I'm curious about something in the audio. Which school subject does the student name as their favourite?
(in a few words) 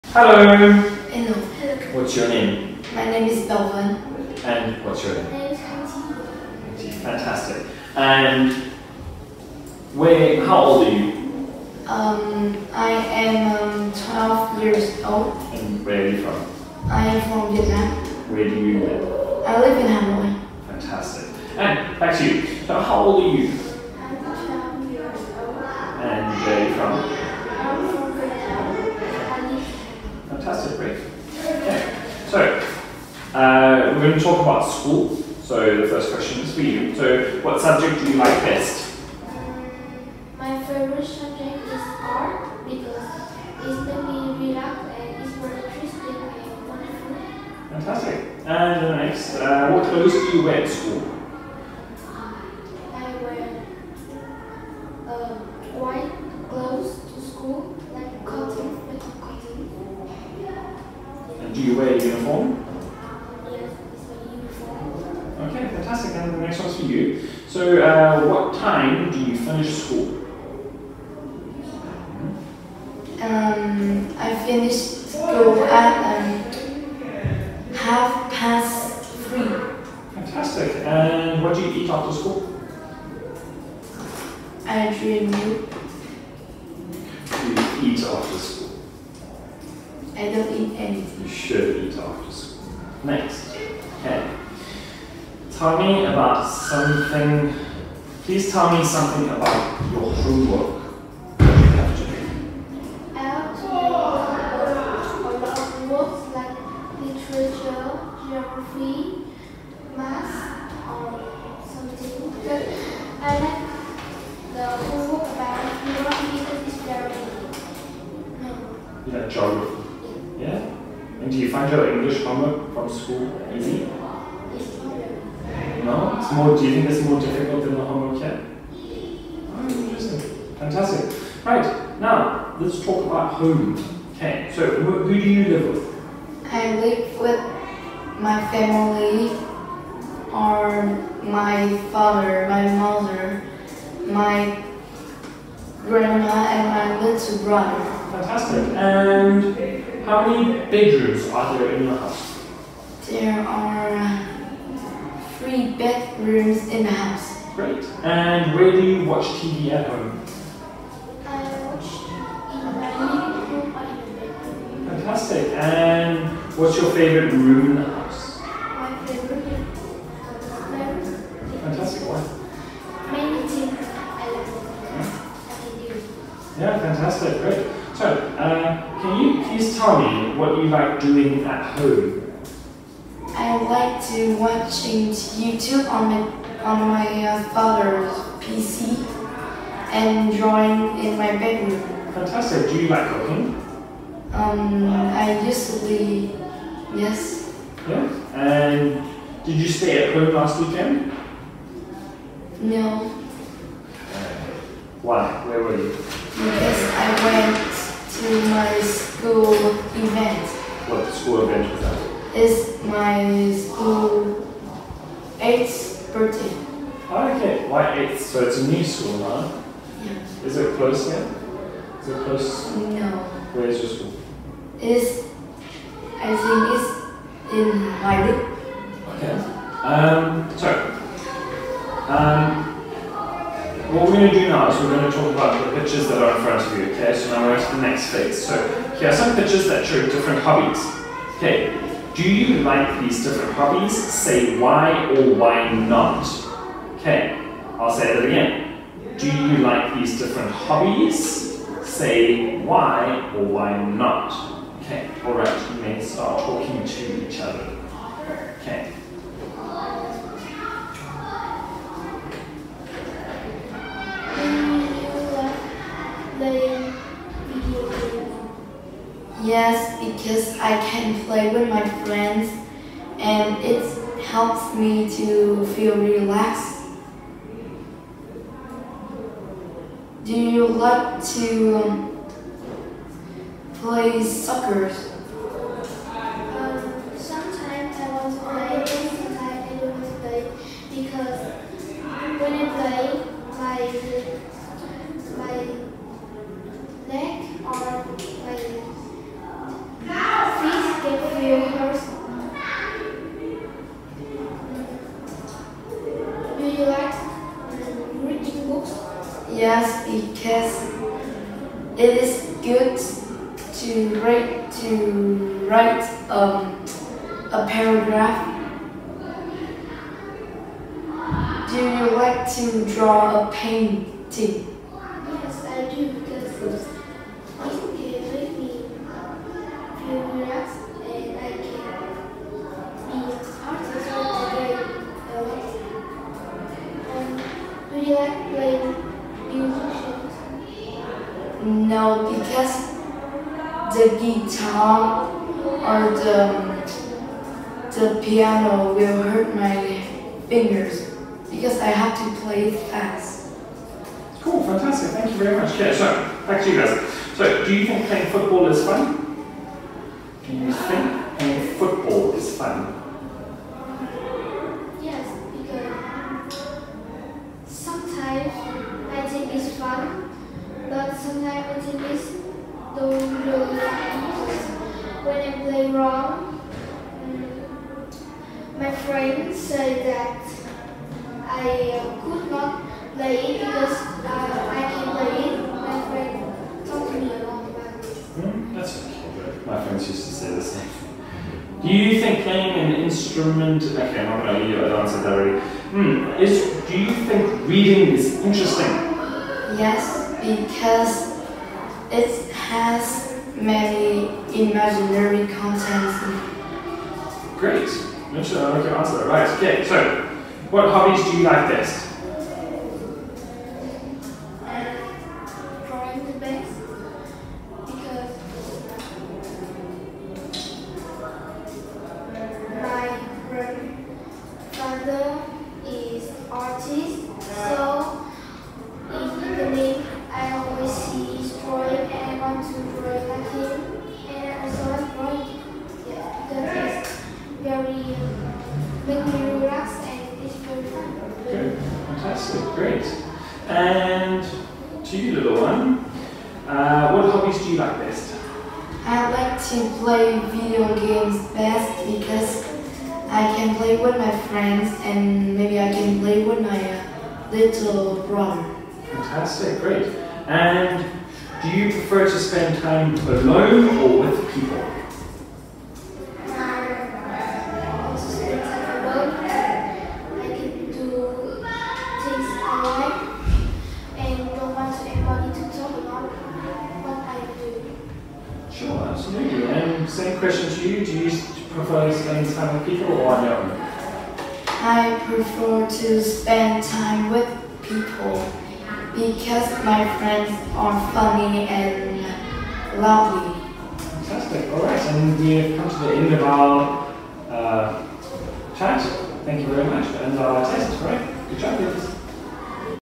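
Art.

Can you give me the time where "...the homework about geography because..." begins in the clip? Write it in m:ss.
1:54.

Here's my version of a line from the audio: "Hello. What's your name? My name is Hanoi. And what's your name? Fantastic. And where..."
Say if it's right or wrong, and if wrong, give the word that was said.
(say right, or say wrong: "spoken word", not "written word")
wrong: "Belvin", not "Hanoi".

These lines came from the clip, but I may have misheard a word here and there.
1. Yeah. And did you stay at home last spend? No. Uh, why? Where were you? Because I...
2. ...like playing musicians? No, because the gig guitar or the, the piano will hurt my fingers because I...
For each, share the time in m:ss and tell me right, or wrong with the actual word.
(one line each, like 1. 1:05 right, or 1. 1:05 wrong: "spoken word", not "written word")
1. 3:17 wrong: "weekend", not "spend"
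2. 5:38 right.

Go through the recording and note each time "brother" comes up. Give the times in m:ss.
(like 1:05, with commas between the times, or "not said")
2:27, 7:38.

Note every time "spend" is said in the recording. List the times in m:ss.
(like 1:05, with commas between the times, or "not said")
7:42, 8:02, 8:06.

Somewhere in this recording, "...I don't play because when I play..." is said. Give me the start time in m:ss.
4:49.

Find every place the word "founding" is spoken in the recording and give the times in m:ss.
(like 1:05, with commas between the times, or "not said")
not said.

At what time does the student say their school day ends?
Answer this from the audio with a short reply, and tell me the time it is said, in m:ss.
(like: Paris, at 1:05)
Half past three, at 1:17.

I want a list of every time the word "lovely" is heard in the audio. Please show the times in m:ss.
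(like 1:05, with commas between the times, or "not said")
8:12.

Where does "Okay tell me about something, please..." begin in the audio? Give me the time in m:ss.
1:34.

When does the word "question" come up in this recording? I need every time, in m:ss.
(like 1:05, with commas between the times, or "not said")
0:36, 8:00.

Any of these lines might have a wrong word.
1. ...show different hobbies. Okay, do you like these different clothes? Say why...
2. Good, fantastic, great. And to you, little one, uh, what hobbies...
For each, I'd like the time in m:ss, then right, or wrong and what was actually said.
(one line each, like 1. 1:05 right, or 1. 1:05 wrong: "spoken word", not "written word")
1. 3:59 wrong: "hobbies", not "clothes"
2. 7:21 right.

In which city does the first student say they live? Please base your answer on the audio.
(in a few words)
Hanoi.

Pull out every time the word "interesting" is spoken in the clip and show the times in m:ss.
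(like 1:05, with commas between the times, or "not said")
0:45, 2:09, 6:38.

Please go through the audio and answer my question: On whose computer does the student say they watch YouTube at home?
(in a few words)
Father's PC.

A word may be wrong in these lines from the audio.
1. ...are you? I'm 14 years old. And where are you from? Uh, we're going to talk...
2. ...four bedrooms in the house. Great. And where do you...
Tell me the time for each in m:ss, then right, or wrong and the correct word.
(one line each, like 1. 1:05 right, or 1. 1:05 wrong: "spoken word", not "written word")
1. 0:23 wrong: "12", not "14"
2. 2:35 wrong: "three", not "four".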